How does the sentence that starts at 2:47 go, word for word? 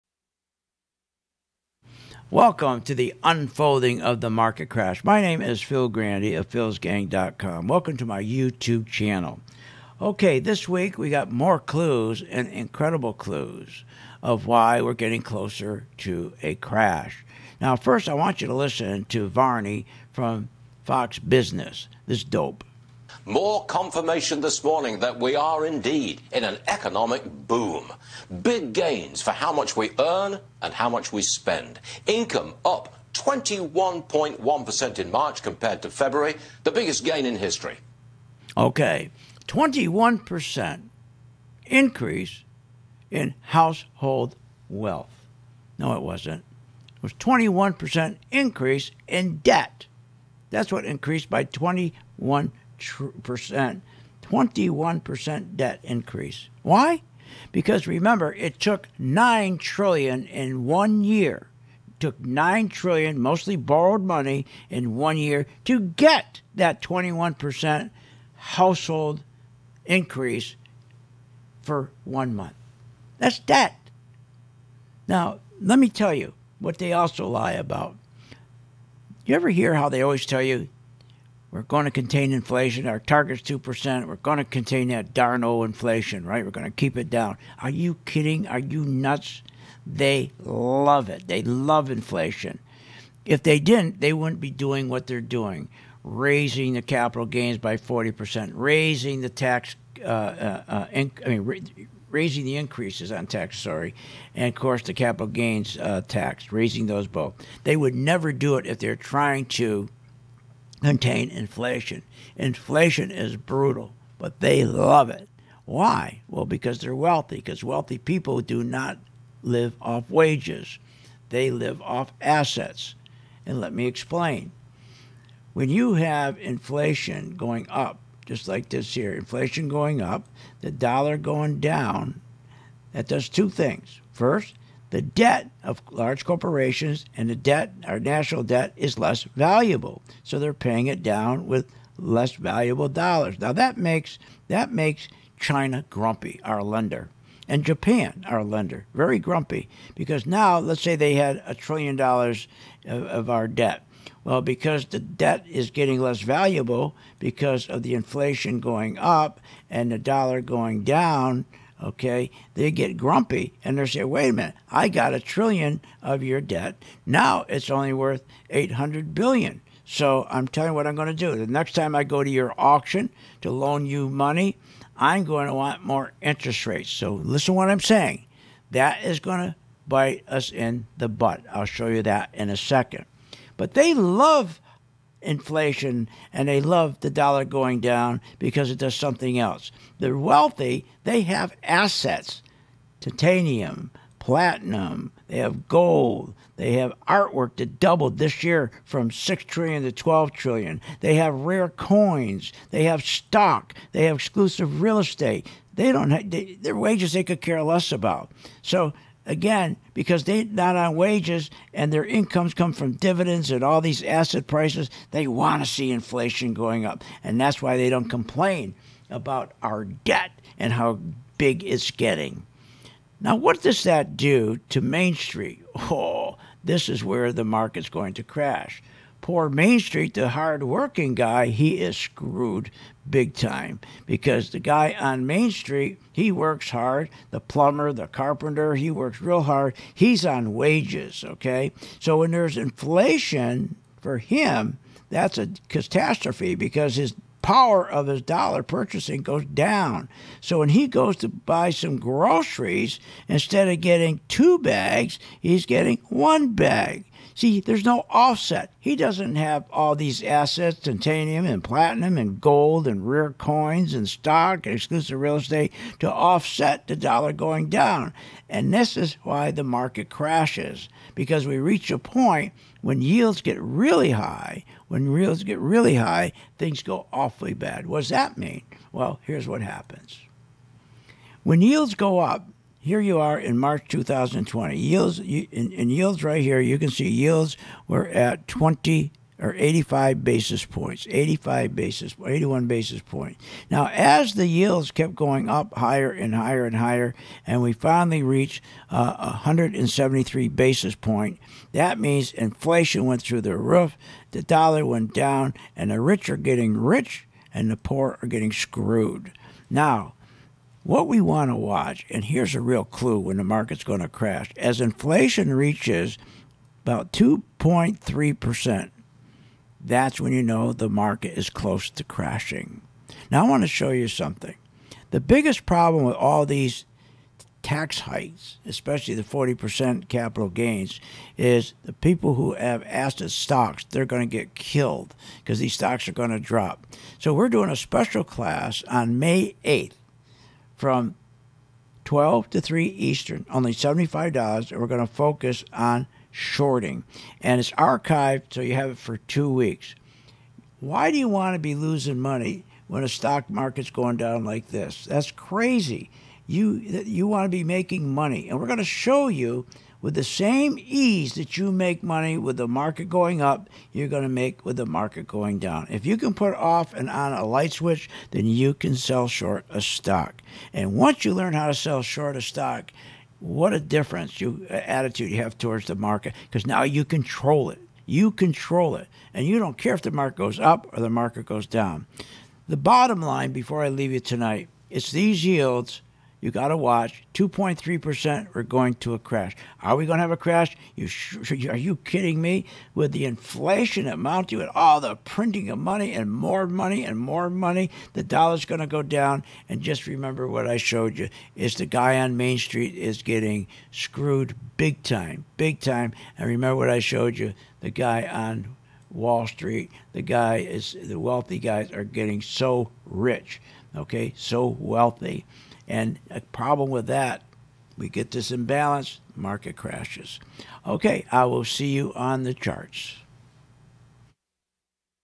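Now it's only worth 800 billion.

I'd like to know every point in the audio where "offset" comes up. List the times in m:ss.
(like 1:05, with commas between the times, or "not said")
4:18, 4:26.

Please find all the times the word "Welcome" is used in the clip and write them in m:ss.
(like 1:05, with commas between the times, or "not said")
0:02, 0:07.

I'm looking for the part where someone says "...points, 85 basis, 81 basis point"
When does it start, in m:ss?
4:50.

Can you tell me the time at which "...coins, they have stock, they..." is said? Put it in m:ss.
3:21.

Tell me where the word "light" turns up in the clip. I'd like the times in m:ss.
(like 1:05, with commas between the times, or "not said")
6:07.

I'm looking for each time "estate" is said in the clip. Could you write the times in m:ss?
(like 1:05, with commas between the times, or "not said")
3:24, 4:25.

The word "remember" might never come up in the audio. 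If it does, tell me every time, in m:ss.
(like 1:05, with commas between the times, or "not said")
0:57, 6:40, 6:46.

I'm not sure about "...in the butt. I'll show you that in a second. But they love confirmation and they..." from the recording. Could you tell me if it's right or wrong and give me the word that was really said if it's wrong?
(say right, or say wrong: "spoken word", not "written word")
wrong: "inflation", not "confirmation".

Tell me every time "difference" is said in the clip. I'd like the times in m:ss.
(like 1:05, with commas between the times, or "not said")
6:13.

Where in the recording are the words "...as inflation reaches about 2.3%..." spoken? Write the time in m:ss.
5:14.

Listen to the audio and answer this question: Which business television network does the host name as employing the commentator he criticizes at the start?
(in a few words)
Fox Business.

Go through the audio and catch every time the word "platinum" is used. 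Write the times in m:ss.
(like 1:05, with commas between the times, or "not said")
3:14, 4:21.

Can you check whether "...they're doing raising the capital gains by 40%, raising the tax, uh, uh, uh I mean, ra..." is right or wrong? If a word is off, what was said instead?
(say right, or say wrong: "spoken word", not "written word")
right.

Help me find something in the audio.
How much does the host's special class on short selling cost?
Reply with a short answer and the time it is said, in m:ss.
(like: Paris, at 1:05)
$75, at 5:43.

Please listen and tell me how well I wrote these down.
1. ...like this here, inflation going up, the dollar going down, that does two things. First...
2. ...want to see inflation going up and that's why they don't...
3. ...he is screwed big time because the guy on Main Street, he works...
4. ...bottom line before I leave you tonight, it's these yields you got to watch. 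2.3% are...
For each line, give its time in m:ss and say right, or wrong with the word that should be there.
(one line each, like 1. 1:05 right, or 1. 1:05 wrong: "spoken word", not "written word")
1. 2:08 right
2. 3:35 right
3. 3:51 right
4. 6:22 right.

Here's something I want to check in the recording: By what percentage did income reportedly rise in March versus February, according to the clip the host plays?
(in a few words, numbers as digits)
21.1%.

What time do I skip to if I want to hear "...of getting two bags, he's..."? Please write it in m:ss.
4:13.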